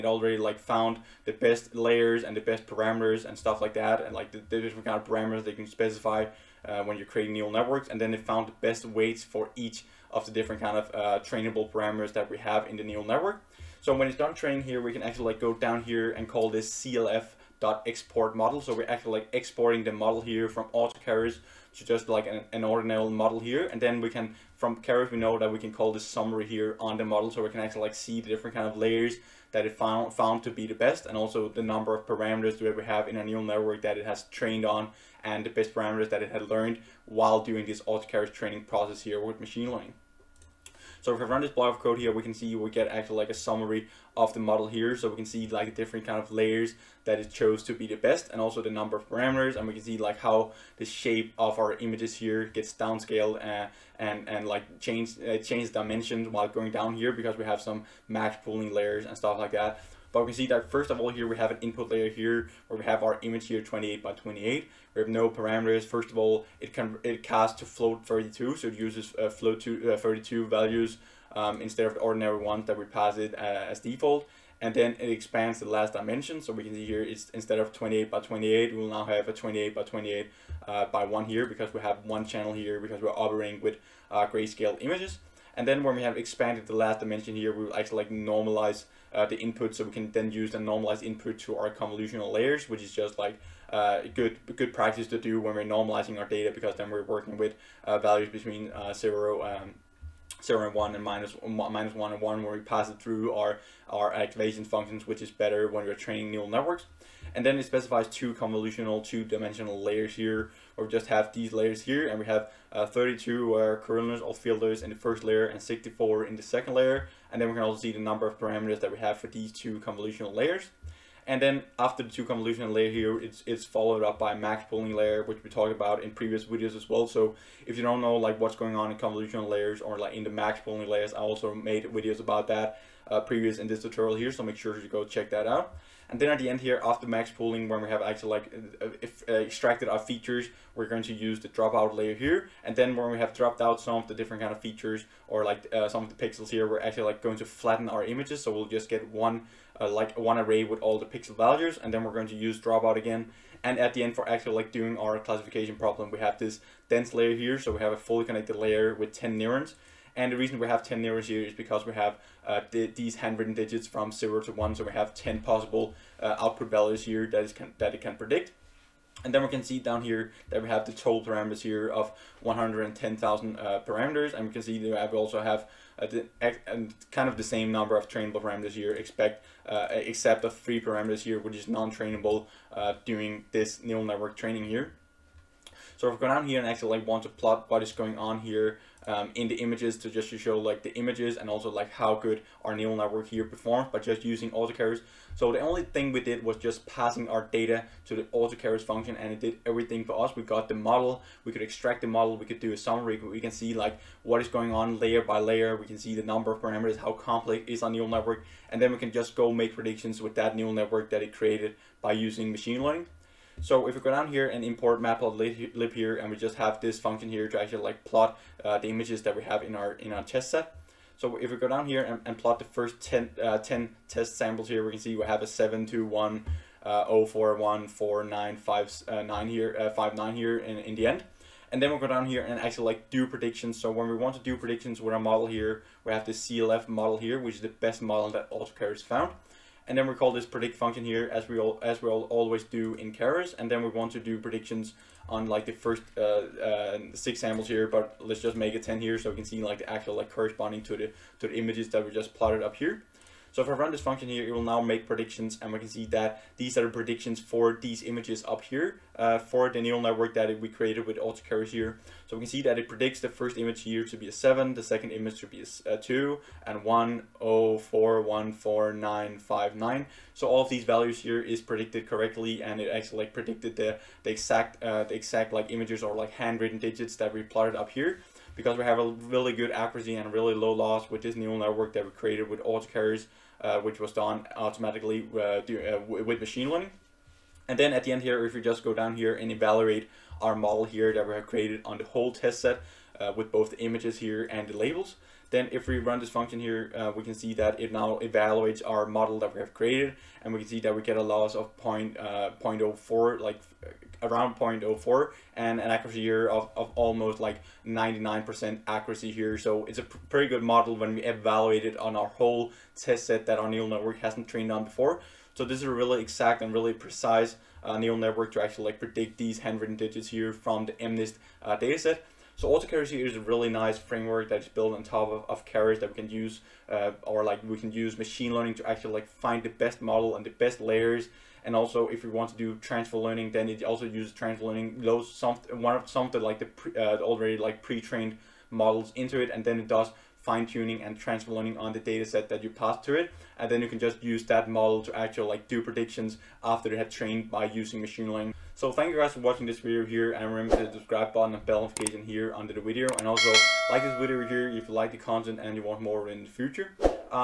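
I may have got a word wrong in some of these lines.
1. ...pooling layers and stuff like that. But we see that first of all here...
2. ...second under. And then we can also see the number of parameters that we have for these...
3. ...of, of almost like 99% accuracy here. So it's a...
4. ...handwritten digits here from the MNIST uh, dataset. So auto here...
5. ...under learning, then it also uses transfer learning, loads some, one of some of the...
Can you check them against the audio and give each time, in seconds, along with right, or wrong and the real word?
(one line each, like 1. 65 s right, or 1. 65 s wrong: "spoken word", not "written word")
1. 58 s right
2. 116 s wrong: "layer", not "under"
3. 306 s right
4. 319 s right
5. 332 s wrong: "transfer", not "under".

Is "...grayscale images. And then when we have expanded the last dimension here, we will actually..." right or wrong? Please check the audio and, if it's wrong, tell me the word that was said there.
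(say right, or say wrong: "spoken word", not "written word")
right.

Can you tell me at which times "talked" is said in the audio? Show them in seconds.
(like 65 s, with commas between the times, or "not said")
125 s.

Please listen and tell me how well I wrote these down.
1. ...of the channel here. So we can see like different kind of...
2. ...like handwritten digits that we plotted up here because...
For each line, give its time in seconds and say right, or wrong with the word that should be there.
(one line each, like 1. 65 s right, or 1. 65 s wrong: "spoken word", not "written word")
1. 44 s wrong: "model", not "channel"
2. 276 s right.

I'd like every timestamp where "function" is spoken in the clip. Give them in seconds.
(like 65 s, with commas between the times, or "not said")
104 s, 198 s, 216 s, 240 s, 254 s, 296 s.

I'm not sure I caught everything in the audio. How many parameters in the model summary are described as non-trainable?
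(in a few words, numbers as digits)
3.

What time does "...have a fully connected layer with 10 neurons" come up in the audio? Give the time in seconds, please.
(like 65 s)
157 s.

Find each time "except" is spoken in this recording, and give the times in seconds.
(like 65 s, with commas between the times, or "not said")
179 s.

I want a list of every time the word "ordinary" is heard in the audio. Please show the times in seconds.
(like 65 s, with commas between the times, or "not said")
22 s, 71 s.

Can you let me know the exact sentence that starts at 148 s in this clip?
So we'll just get one uh, like one array with all the pixel values.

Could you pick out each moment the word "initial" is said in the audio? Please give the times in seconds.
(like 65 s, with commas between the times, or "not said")
not said.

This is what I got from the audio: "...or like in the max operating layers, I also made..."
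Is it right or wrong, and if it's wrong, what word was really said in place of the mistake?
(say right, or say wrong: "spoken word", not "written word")
wrong: "pooling", not "operating".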